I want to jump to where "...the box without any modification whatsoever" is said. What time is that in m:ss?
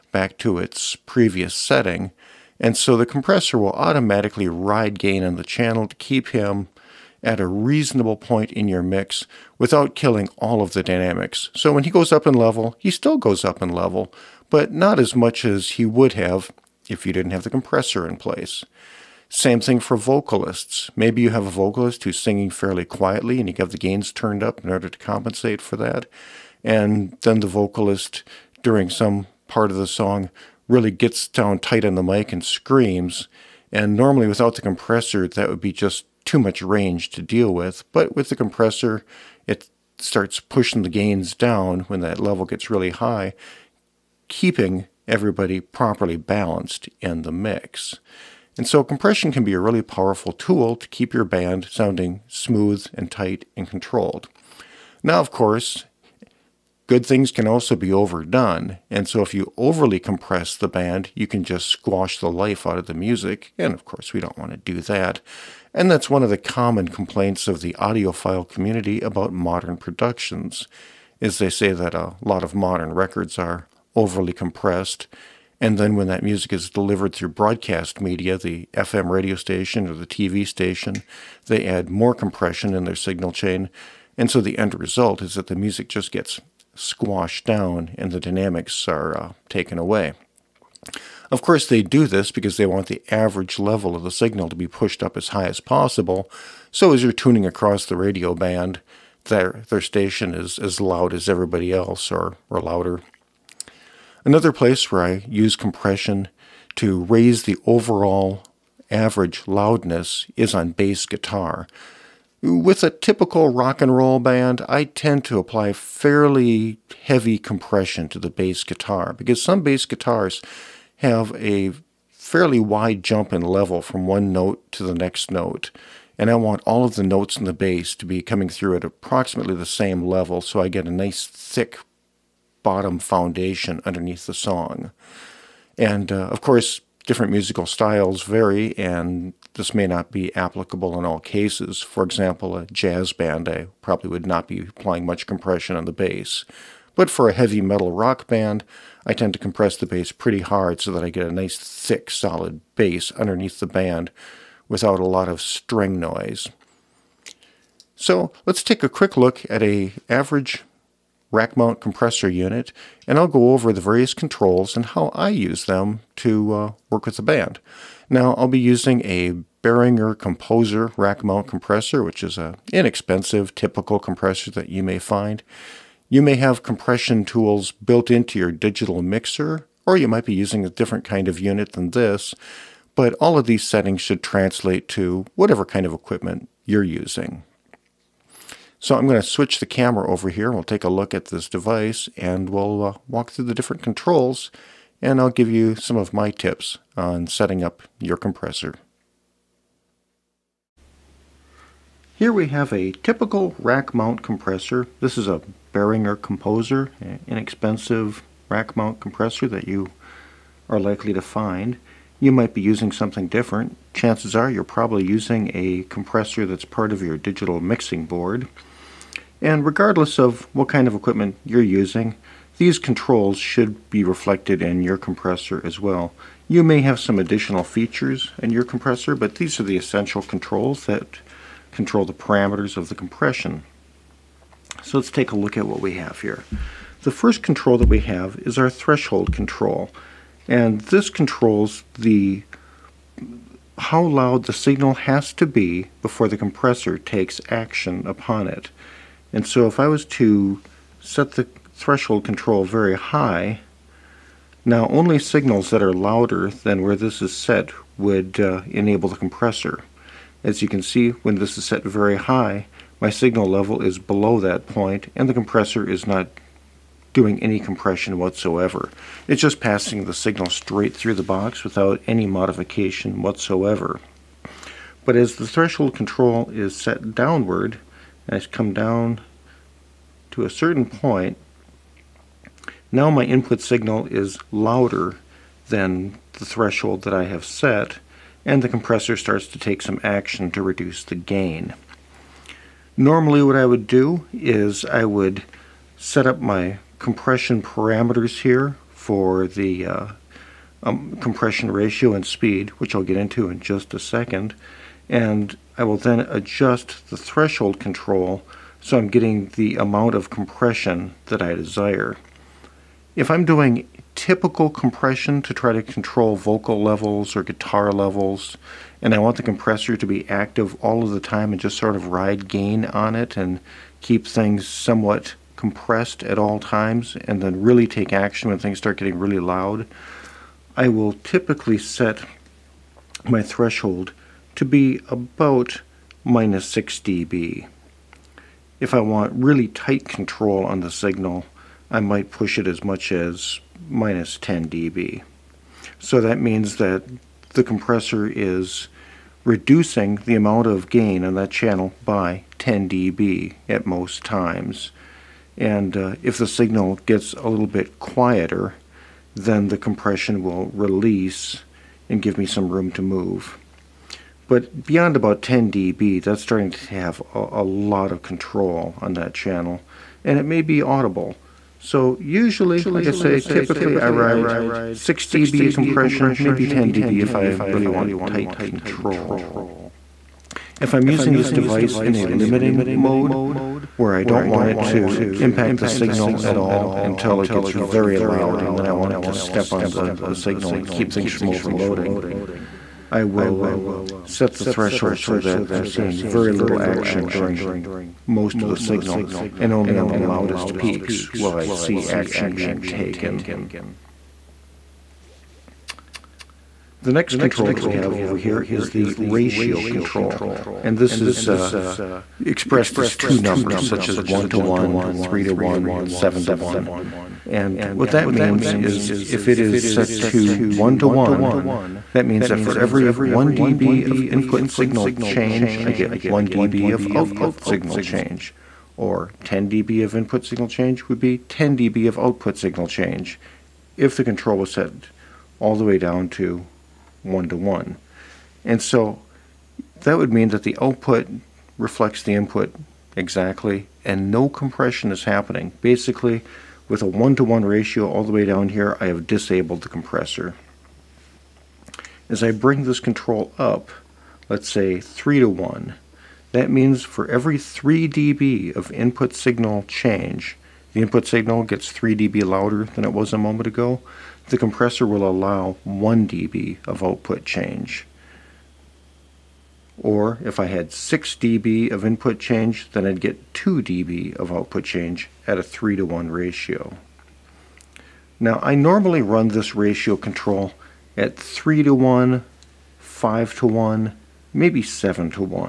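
4:31.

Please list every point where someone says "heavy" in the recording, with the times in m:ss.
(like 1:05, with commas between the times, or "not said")
1:57, 2:27.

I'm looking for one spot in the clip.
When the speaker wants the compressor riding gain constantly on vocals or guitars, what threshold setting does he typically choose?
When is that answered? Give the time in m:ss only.
5:36.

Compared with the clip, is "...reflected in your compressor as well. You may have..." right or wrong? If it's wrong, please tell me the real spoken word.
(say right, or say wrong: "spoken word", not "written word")
right.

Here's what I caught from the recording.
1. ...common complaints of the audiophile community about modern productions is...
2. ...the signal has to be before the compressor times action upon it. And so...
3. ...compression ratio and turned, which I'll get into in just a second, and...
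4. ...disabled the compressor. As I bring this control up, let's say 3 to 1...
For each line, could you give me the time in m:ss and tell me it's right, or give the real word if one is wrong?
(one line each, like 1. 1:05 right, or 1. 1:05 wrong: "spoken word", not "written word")
1. 1:06 right
2. 4:04 wrong: "takes", not "times"
3. 5:01 wrong: "speed", not "turned"
4. 7:29 right.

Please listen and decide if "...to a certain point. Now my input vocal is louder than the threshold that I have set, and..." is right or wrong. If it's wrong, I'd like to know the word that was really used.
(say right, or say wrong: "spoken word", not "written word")
wrong: "signal", not "vocal".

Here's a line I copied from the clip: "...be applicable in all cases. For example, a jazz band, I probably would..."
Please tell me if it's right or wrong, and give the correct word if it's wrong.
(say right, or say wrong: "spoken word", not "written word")
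right.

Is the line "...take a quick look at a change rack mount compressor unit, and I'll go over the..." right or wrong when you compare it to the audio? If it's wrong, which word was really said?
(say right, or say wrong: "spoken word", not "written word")
wrong: "average", not "change".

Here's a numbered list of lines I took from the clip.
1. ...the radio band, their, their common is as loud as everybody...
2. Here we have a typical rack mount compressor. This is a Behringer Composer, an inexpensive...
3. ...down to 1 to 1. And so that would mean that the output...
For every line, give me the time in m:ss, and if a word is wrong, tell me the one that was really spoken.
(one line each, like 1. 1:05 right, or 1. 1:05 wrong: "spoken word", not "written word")
1. 1:37 wrong: "station", not "common"
2. 3:22 right
3. 7:15 right.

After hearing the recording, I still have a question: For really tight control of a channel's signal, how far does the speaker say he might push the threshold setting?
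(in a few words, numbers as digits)
-10 dB.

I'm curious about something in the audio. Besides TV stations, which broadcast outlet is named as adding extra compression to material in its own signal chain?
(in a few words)
FM radio station.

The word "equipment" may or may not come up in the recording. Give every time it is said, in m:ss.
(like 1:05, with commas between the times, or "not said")
3:05, 3:40.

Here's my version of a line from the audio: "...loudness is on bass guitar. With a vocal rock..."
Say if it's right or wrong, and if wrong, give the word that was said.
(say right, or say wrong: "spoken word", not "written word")
wrong: "typical", not "vocal".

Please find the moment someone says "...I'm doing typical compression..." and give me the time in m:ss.
5:13.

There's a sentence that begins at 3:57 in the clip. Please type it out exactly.
The first control that we have is our threshold control.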